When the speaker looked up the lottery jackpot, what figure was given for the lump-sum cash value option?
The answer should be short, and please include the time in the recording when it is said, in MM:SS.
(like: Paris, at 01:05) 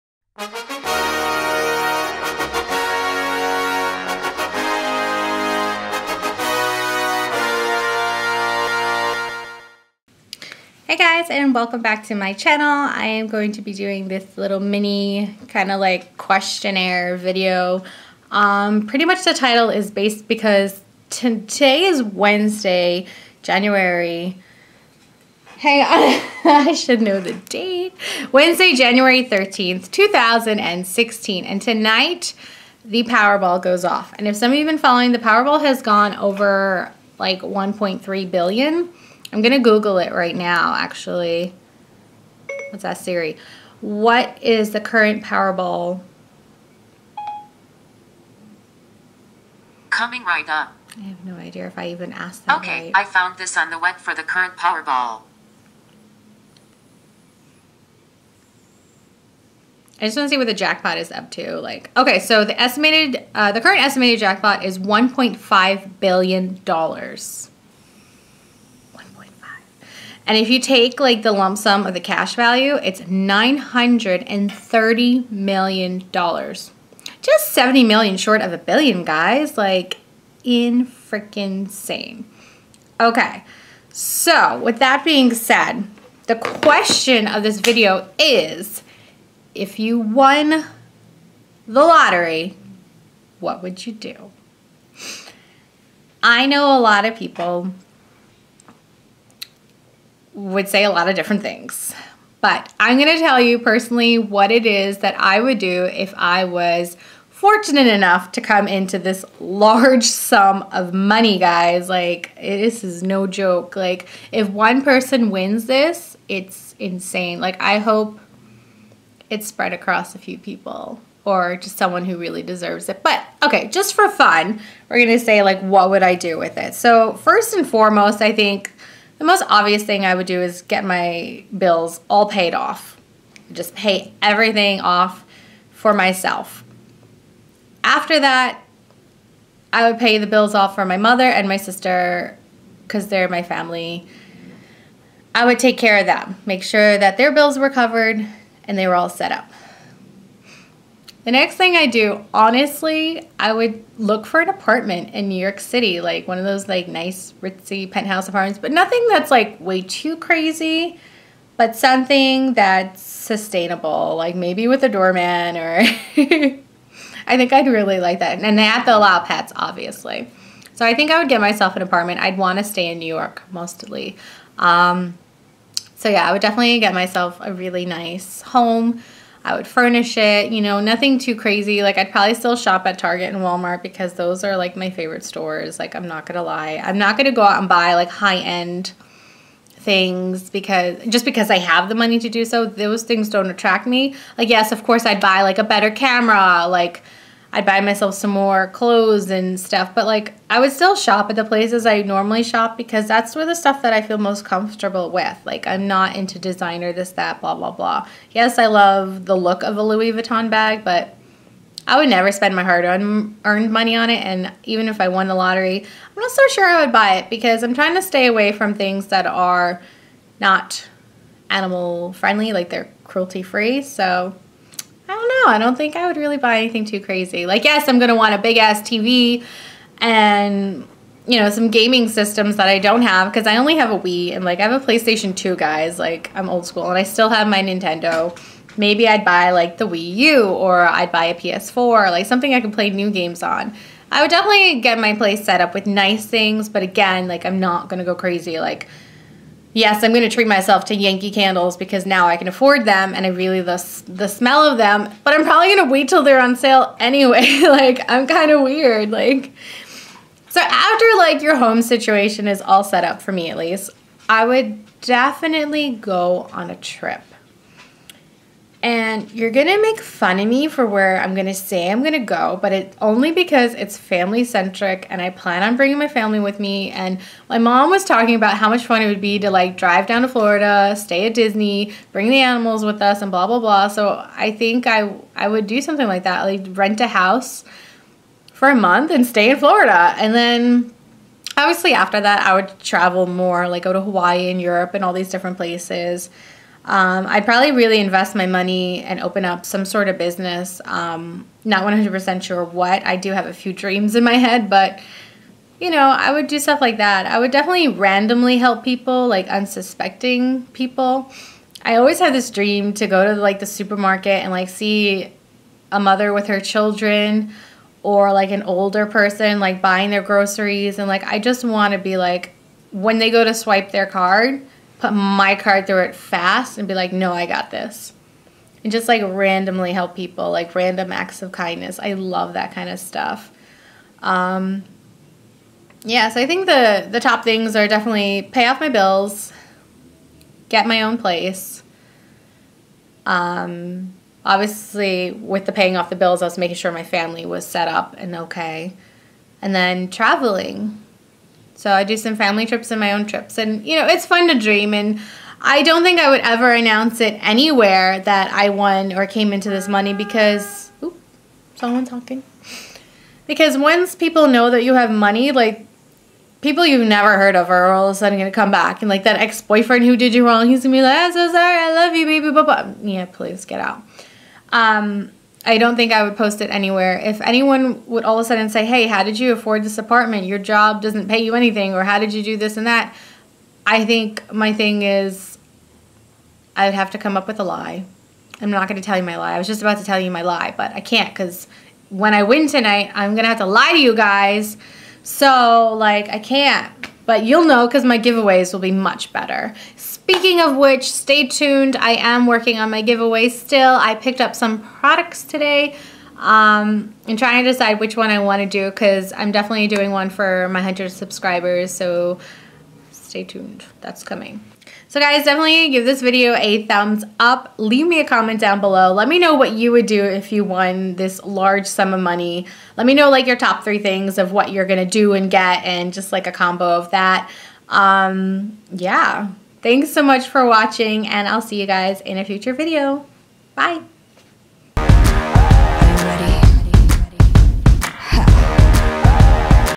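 $930 million, at 01:13.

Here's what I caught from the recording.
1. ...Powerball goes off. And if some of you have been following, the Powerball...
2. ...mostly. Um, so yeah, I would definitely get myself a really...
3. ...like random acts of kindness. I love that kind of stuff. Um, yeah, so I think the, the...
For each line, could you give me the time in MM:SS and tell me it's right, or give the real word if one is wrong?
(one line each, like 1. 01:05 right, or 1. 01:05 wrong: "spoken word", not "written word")
1. 00:33 right
2. 02:53 right
3. 05:30 right.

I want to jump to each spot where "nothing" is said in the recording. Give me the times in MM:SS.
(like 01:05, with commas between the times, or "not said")
02:38, 03:00.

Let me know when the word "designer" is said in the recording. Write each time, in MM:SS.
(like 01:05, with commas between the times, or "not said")
03:26.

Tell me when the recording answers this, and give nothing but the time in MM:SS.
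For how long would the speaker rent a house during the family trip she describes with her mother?
04:48.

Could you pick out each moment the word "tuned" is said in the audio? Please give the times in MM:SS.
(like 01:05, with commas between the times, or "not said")
06:41, 06:53.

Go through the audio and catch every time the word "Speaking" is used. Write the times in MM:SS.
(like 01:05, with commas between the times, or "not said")
06:39.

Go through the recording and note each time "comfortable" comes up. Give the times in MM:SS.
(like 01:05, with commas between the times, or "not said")
03:24.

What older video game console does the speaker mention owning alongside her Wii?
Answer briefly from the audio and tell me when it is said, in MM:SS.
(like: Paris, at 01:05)
PlayStation 2, at 03:54.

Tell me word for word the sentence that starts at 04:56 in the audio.
Um, I'd probably really invest my money and open up some sort of business.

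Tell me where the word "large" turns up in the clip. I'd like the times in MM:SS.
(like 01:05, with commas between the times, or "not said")
01:49, 07:01.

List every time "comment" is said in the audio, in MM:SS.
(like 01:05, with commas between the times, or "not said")
06:58.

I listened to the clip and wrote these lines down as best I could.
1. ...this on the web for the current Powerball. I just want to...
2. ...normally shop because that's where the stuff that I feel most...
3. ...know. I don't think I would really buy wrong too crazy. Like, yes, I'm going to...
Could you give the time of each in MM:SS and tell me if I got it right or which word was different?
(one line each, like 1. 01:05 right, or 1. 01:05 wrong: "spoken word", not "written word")
1. 00:53 right
2. 03:22 right
3. 03:45 wrong: "anything", not "wrong".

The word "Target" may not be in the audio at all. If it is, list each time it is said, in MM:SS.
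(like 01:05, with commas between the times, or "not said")
03:02.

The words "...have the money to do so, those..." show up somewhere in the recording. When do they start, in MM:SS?
03:11.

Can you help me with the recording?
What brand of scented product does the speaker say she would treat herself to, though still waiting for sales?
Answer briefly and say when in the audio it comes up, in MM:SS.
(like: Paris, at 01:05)
Yankee candles, at 04:10.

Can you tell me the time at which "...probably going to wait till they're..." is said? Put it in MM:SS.
04:15.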